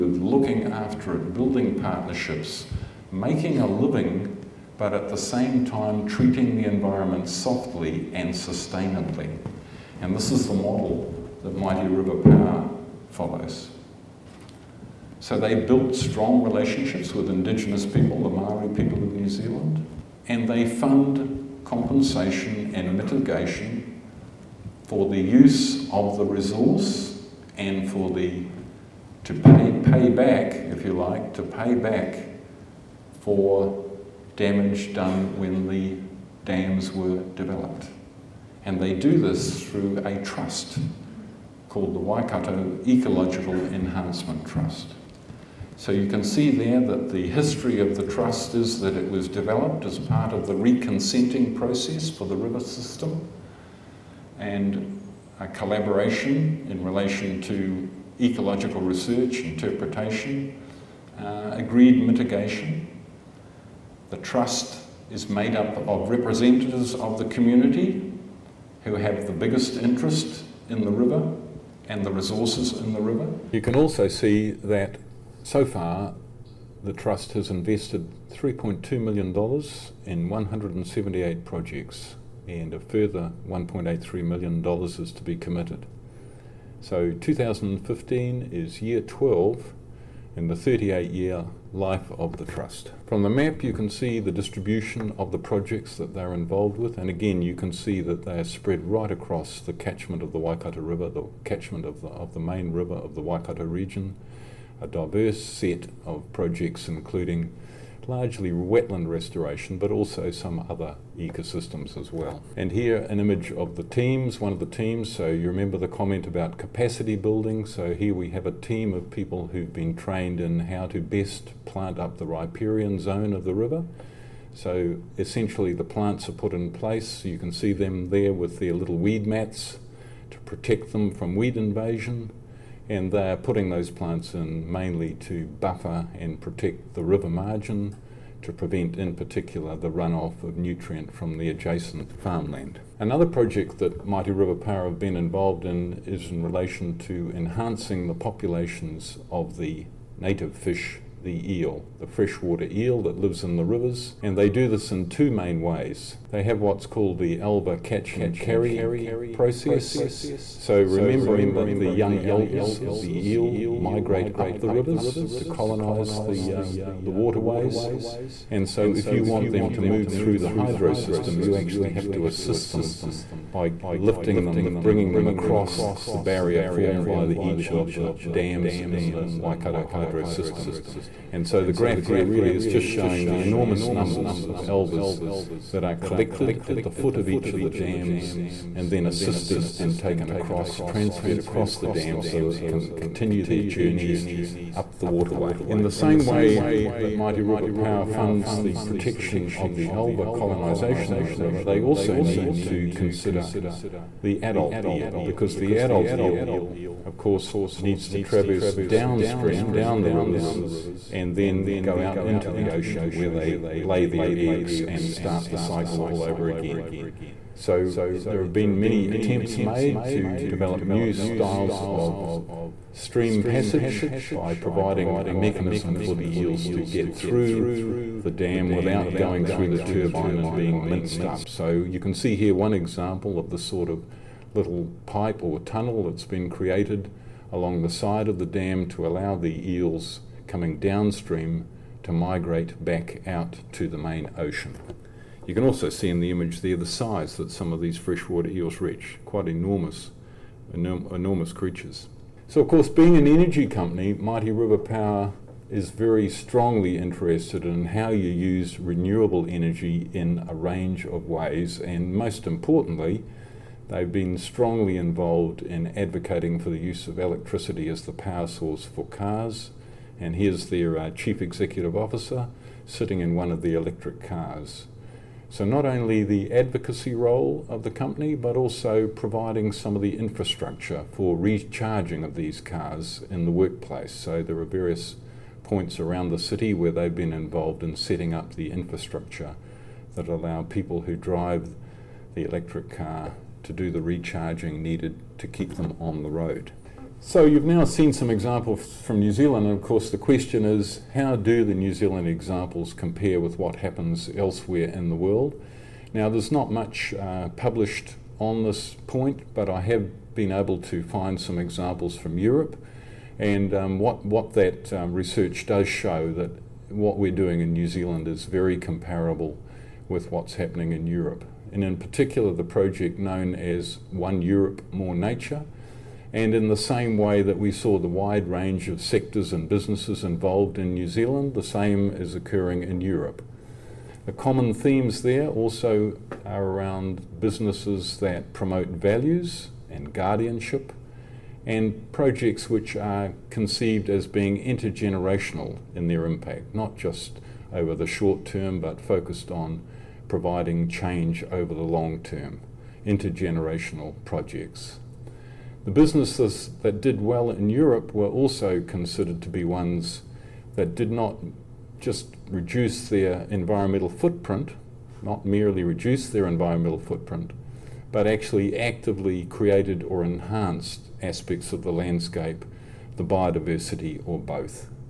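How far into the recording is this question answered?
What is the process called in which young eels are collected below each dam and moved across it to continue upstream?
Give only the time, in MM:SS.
02:37.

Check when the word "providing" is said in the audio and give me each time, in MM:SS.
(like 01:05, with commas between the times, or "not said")
03:44, 04:39, 05:50.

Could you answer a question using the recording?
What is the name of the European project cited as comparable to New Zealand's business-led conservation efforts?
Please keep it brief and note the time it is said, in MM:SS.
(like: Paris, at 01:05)
One Europe, More Nature, at 05:24.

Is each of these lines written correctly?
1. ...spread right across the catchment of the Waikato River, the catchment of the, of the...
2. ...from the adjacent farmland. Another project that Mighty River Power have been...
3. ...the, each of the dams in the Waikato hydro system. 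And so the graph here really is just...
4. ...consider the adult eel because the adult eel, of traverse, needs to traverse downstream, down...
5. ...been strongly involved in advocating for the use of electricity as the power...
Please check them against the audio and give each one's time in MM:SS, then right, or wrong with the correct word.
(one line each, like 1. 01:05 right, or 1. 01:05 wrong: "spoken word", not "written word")
1. 01:38 right
2. 02:21 right
3. 02:57 right
4. 03:22 wrong: "course", not "traverse"
5. 04:24 right.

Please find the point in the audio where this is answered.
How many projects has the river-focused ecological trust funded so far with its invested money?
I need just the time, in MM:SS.
01:20.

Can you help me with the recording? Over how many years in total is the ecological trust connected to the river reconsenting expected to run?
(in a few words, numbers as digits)
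38 years.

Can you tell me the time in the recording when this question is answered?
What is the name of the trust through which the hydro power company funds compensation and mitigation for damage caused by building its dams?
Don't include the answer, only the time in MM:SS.
00:41.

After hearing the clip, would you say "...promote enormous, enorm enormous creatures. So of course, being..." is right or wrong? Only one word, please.
wrong.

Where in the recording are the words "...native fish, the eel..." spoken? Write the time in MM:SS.
02:30.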